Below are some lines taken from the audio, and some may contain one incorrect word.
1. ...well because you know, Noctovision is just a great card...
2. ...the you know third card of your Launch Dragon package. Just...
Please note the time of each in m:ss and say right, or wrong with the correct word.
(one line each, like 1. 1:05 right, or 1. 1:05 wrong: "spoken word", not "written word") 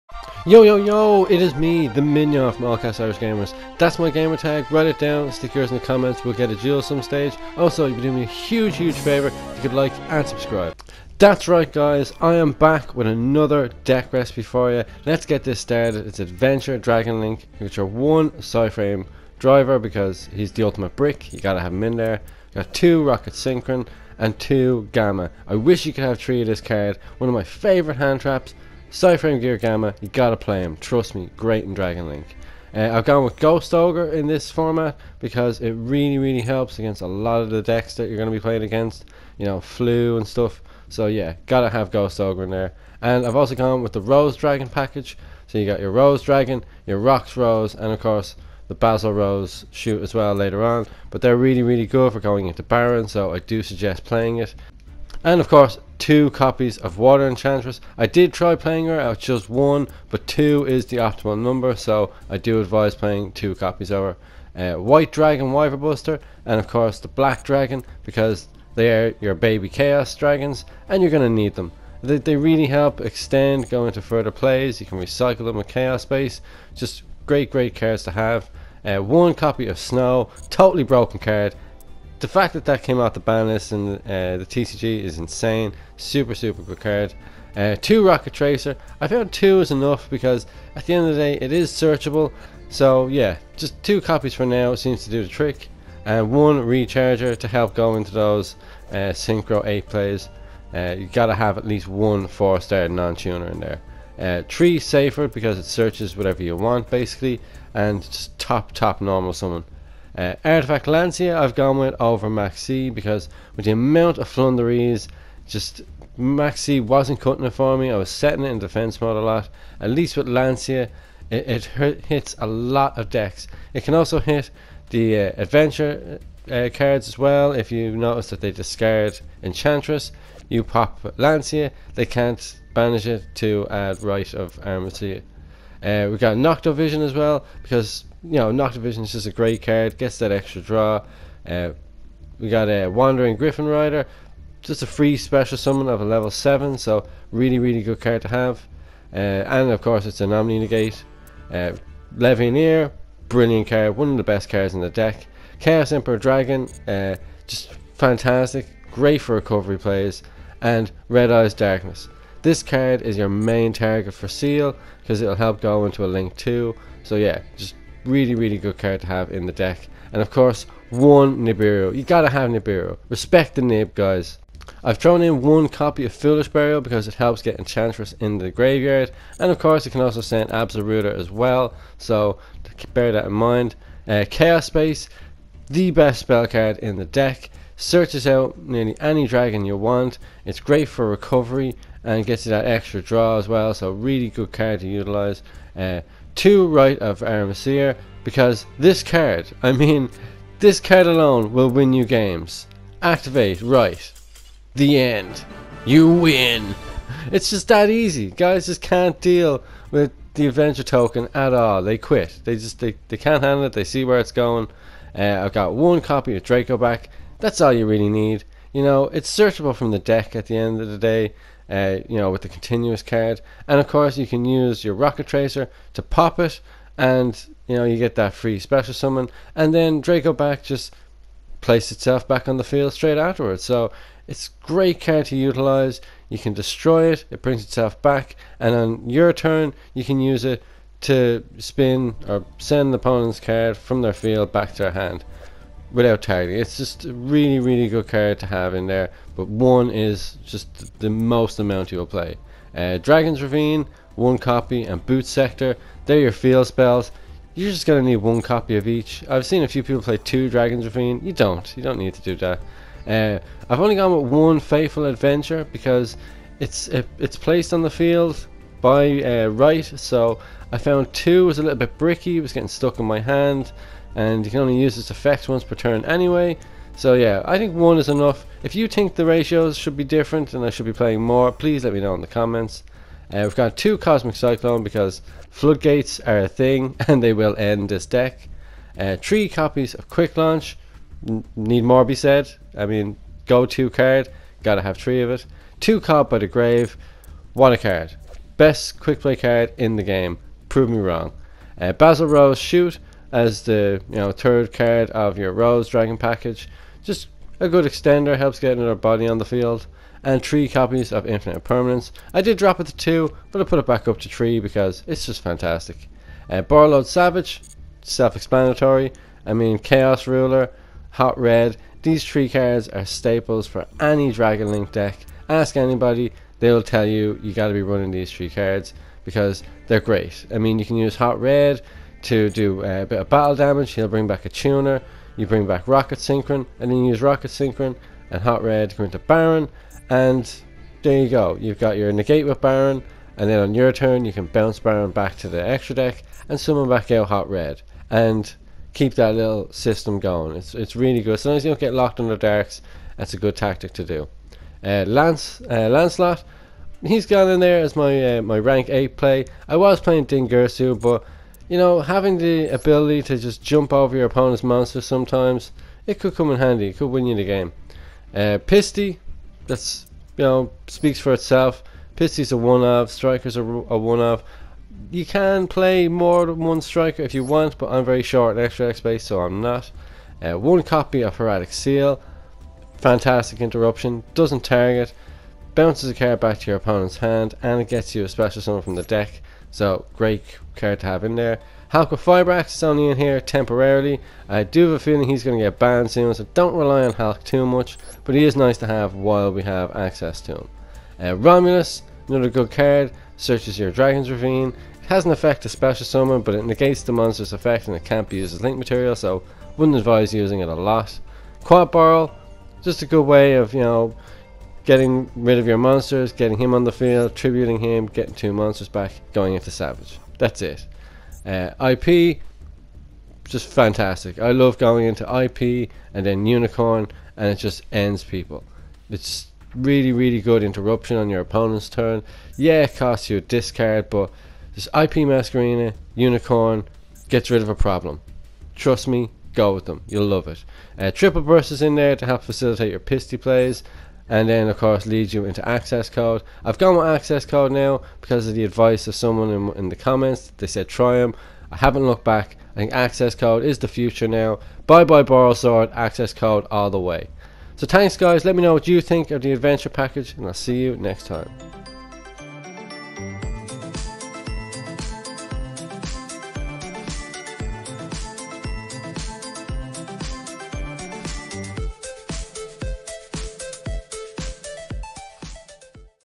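1. 2:17 right
2. 5:03 wrong: "Rose", not "Launch".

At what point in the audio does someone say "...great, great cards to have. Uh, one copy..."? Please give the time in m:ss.
1:17.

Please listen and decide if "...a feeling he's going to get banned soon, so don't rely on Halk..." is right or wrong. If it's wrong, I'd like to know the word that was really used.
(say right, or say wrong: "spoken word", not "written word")
right.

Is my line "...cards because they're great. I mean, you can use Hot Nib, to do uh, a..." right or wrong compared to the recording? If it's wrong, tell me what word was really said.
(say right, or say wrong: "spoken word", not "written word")
wrong: "Red", not "Nib".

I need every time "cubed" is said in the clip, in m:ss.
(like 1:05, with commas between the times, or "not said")
not said.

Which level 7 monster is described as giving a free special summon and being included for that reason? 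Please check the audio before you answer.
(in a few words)
Wandering Gryphon Rider.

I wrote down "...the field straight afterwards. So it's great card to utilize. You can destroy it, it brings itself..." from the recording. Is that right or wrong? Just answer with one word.
right.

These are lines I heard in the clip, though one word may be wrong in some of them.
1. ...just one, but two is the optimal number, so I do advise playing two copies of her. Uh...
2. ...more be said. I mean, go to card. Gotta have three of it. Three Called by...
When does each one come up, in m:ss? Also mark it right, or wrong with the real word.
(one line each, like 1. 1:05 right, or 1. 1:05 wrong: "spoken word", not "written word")
1. 0:59 right
2. 4:51 wrong: "Two", not "Three".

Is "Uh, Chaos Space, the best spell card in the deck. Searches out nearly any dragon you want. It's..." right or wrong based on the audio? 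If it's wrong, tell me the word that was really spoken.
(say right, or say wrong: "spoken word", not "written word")
right.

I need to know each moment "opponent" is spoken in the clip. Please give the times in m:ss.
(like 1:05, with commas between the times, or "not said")
4:02, 6:04, 6:26, 7:11.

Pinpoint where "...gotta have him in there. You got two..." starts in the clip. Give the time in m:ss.
0:21.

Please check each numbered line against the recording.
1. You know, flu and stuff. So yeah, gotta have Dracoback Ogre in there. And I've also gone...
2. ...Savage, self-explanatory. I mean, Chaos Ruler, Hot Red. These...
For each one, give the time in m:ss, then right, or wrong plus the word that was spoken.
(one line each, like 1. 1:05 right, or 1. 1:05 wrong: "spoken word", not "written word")
1. 0:39 wrong: "Ghost", not "Dracoback"
2. 5:17 right.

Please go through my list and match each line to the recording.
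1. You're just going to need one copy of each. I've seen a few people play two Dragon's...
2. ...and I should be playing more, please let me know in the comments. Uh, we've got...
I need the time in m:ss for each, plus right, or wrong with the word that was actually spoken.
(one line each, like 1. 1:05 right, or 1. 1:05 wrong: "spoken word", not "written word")
1. 4:17 right
2. 4:40 right.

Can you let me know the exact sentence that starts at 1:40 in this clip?
Uh, you gotta have at least one 4 star non tuner in there.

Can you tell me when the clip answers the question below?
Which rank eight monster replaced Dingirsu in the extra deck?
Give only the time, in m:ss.
5:55.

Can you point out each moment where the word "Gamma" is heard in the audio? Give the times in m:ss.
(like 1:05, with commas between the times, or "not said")
0:24, 0:29.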